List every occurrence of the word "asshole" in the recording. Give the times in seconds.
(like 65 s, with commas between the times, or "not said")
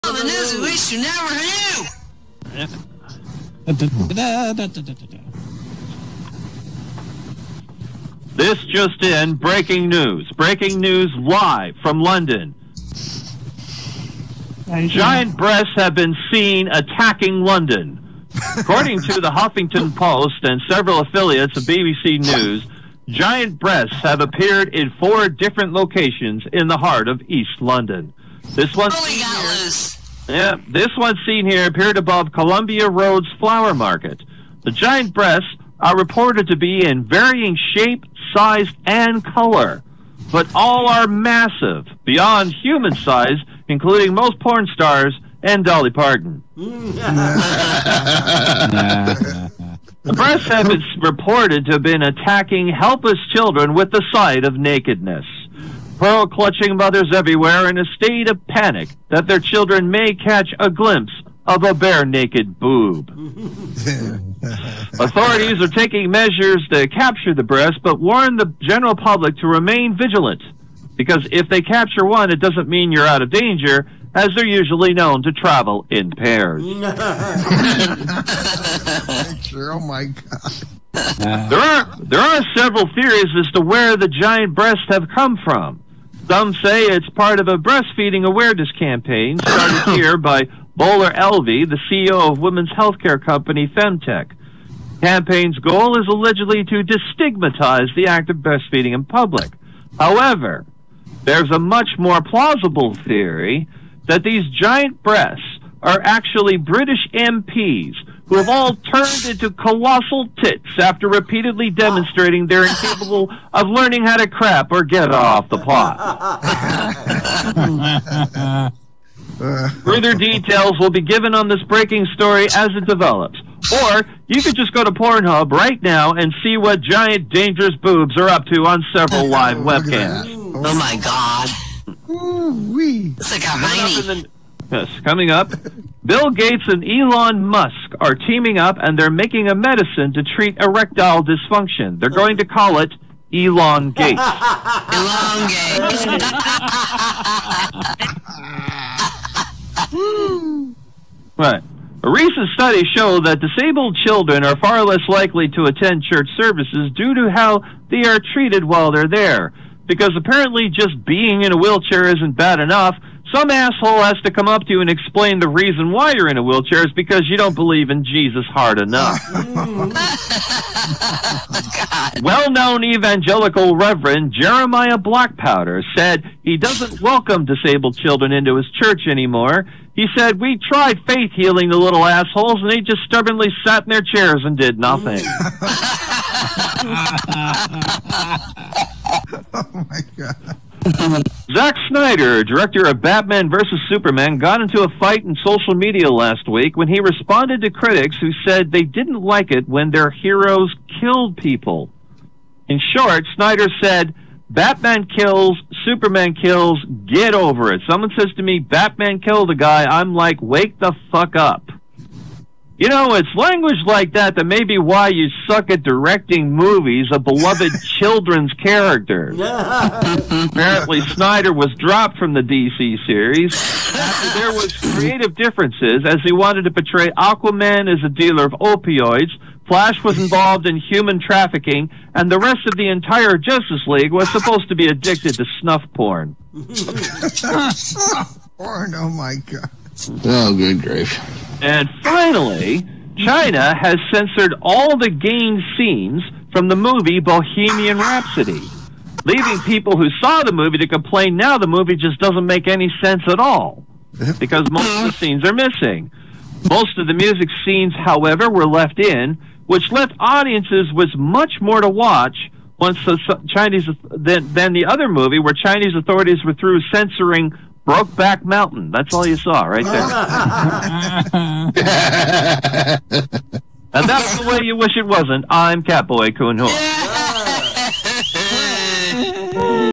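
163 s, 182 s.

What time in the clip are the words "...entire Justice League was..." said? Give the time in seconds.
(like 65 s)
232 s.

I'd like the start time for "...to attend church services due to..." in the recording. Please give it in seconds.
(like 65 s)
155 s.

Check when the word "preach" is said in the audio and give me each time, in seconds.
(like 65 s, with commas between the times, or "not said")
not said.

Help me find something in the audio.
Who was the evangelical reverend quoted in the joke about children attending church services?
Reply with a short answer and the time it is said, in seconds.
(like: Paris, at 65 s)
Jeremiah Blackpowder, at 174 s.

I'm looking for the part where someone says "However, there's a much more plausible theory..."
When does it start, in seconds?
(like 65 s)
99 s.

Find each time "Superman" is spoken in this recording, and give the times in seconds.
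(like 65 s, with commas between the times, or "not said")
193 s, 205 s.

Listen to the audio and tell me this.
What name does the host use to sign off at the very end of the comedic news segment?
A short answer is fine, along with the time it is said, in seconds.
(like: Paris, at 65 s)
Catboy Coonhook, at 275 s.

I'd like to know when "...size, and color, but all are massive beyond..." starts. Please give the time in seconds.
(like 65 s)
38 s.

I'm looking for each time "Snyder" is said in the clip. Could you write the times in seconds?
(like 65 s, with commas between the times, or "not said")
191 s, 203 s, 221 s.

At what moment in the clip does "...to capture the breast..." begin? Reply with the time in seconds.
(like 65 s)
66 s.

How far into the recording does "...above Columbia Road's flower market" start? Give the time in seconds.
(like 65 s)
31 s.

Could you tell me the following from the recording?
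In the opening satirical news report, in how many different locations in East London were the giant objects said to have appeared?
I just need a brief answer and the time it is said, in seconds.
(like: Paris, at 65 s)
4, at 24 s.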